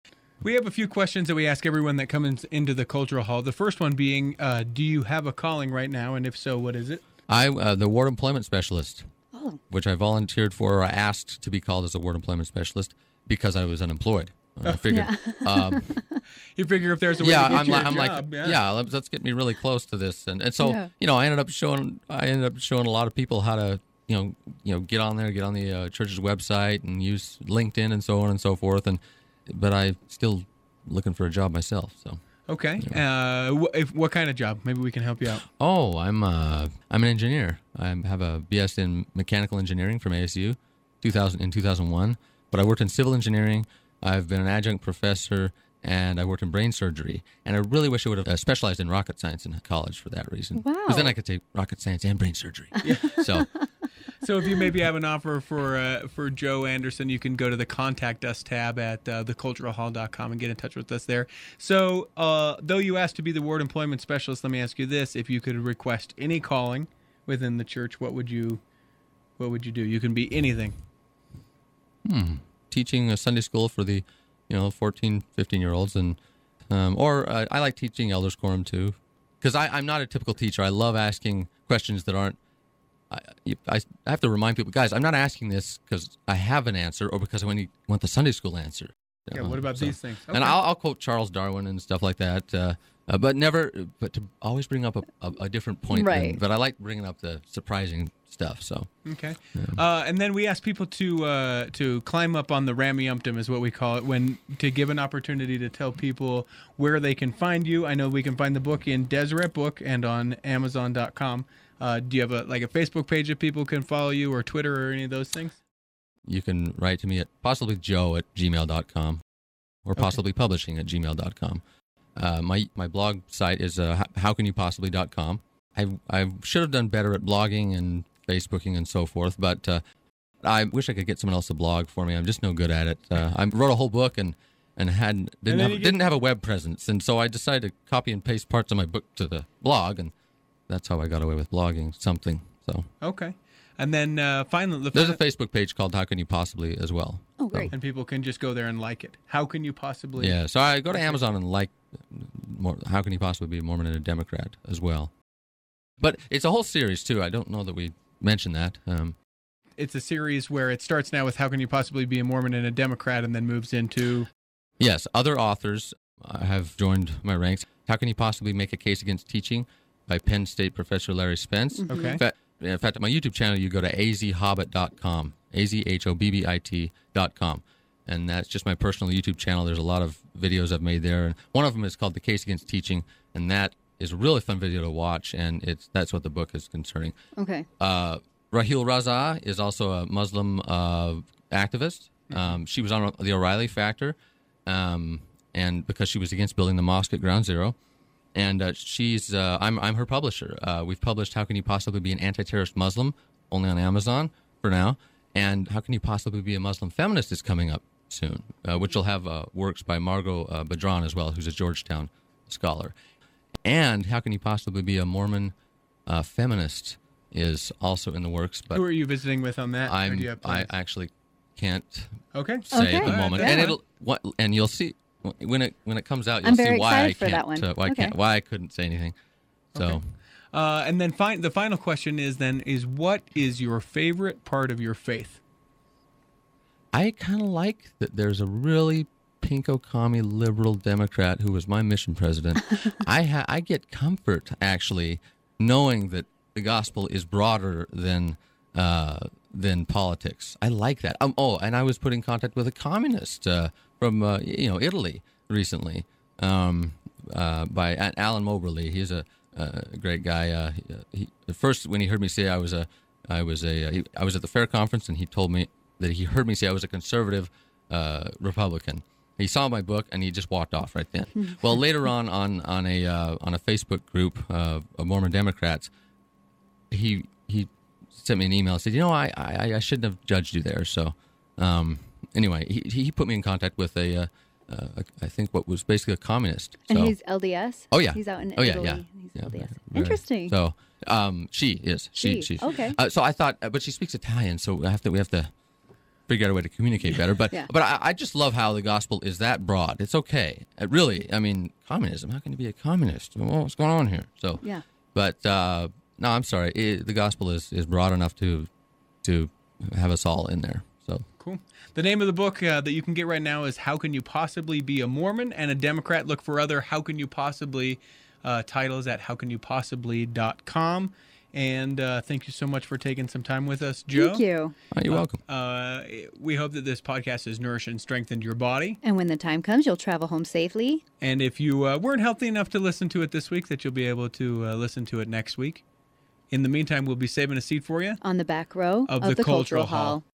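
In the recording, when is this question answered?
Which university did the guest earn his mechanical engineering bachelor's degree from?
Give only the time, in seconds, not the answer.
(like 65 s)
40 s.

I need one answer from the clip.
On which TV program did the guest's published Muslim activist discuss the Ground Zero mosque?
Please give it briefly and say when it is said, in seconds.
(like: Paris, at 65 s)
The O'Reilly Factor, at 193 s.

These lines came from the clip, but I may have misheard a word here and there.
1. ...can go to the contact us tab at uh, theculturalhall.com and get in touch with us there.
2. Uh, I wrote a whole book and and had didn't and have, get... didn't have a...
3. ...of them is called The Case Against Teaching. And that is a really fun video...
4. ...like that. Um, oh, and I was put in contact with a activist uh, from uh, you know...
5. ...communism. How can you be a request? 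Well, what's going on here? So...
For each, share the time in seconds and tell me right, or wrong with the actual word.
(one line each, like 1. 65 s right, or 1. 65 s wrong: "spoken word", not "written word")
1. 57 s right
2. 133 s right
3. 181 s right
4. 250 s wrong: "communist", not "activist"
5. 301 s wrong: "communist", not "request".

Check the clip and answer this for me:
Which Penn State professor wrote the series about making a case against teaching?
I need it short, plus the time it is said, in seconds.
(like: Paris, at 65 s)
Larry Spence, at 171 s.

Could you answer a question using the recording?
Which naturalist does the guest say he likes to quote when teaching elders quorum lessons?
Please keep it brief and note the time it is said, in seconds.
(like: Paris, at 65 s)
Charles Darwin, at 90 s.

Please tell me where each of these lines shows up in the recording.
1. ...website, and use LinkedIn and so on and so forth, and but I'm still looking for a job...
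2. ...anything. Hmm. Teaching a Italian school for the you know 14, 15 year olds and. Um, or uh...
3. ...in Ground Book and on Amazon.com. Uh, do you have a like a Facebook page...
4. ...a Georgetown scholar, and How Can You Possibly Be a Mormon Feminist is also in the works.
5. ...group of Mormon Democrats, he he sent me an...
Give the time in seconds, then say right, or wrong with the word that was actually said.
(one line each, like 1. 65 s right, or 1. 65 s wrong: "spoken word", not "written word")
1. 26 s right
2. 70 s wrong: "Sunday", not "Italian"
3. 108 s wrong: "Deseret", not "Ground"
4. 211 s right
5. 274 s right.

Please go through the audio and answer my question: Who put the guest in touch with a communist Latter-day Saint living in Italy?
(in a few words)
Alan Moberly.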